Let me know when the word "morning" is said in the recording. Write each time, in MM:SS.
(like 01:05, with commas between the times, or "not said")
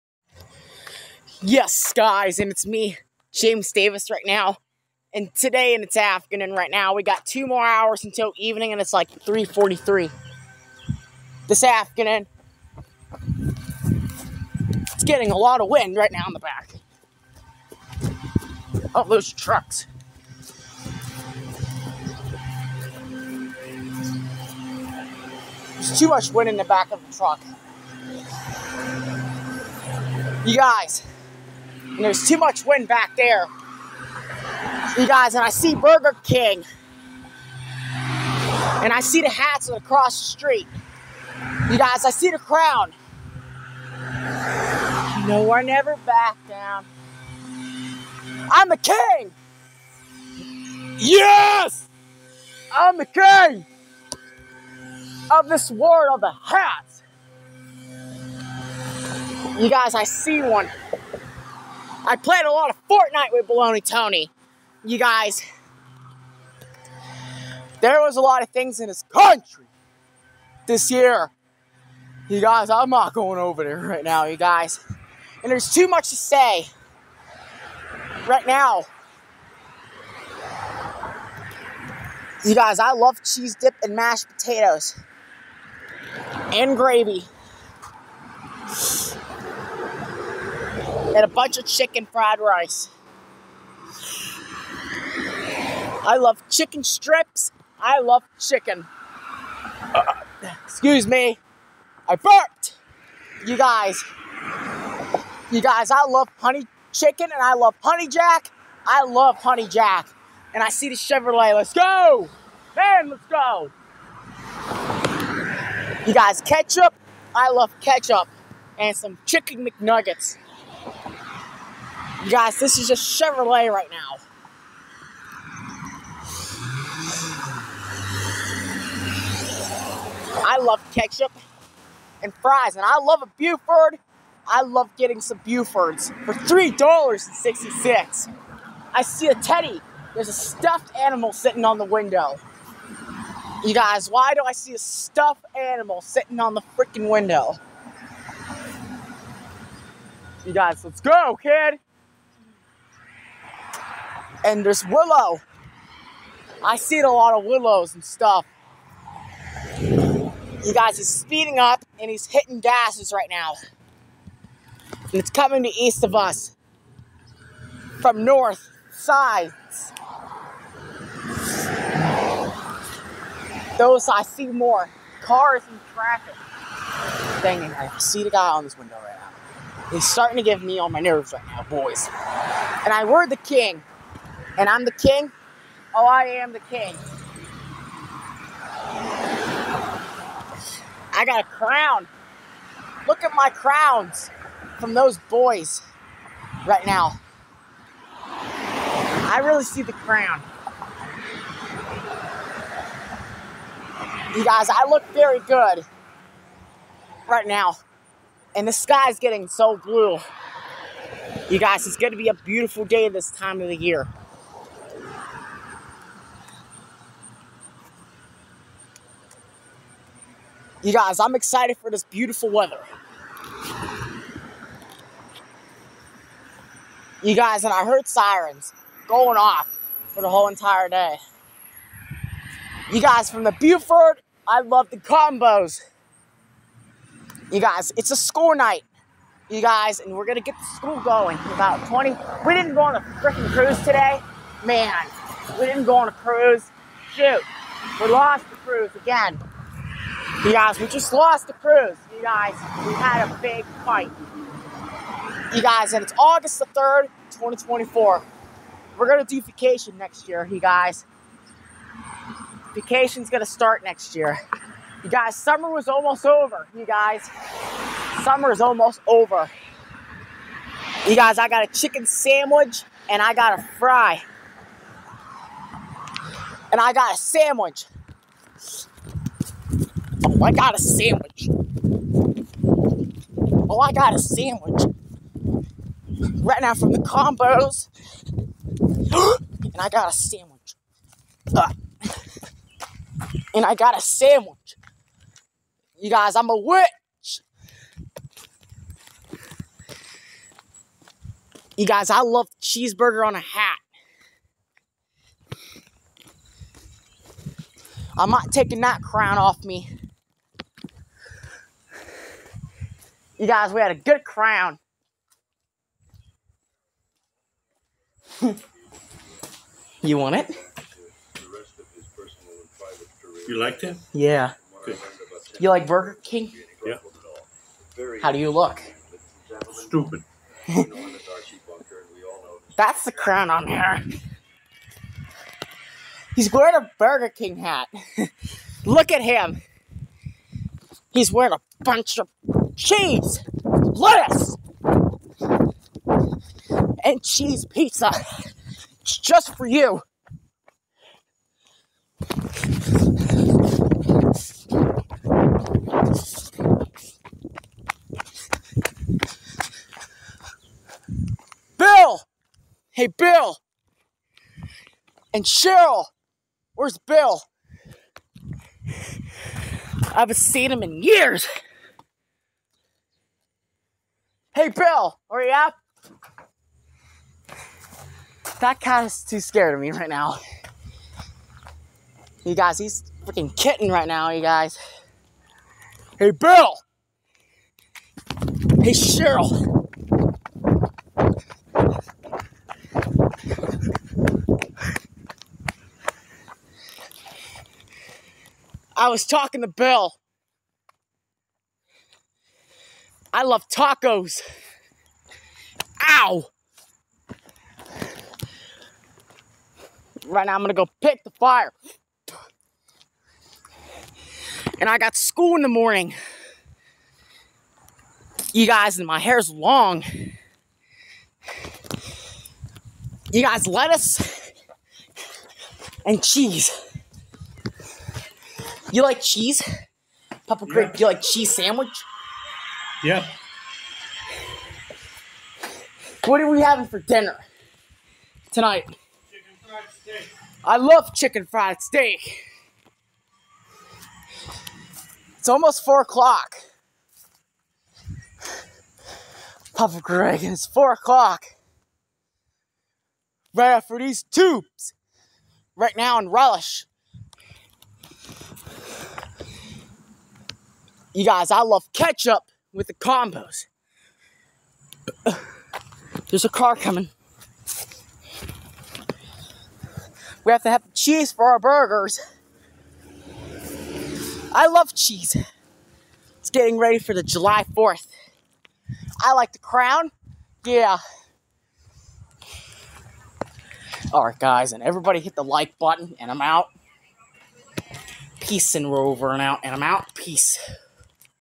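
06:55.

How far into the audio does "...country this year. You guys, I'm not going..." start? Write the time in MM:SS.
01:09.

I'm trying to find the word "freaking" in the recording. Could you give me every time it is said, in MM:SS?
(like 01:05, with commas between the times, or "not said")
02:26, 04:03, 06:23.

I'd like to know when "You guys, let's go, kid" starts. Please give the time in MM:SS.
02:30.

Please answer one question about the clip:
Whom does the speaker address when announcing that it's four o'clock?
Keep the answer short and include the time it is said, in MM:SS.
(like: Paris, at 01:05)
Papa Greg, at 07:29.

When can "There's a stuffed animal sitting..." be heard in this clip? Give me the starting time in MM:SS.
02:20.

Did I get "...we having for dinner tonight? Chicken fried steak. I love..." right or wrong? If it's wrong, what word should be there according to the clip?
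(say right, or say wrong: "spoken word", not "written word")
right.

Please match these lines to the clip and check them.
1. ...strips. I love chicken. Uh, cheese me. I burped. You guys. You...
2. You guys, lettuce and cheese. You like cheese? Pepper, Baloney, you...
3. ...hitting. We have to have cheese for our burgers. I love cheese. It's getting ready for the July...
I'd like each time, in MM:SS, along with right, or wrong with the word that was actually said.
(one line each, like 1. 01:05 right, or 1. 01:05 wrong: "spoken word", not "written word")
1. 01:36 wrong: "excuse", not "cheese"
2. 07:03 wrong: "Creek", not "Baloney"
3. 07:46 wrong: "coming", not "hitting".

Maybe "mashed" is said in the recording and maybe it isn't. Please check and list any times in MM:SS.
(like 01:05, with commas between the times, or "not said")
01:23.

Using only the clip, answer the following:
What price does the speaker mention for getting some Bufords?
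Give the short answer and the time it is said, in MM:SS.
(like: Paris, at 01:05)
$3.66, at 02:16.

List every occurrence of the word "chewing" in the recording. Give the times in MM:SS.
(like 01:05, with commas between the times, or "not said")
not said.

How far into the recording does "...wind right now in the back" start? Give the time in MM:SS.
00:15.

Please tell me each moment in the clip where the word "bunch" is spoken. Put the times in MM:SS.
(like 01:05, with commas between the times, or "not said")
01:31, 05:41.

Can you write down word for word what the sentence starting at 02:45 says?
And it's coming to east of us from north sides.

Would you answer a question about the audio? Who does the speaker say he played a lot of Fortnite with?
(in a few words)
Baloney Tony.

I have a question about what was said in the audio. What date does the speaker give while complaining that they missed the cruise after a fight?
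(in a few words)
August 3, 2024.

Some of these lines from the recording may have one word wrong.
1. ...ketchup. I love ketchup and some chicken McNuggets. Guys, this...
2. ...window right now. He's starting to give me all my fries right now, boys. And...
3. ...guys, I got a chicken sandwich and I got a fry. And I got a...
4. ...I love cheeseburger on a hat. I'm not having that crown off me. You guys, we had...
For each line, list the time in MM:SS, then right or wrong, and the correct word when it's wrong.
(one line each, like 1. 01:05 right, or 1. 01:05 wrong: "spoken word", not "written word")
1. 01:56 right
2. 02:58 wrong: "nerves", not "fries"
3. 04:31 right
4. 05:02 wrong: "taking", not "having".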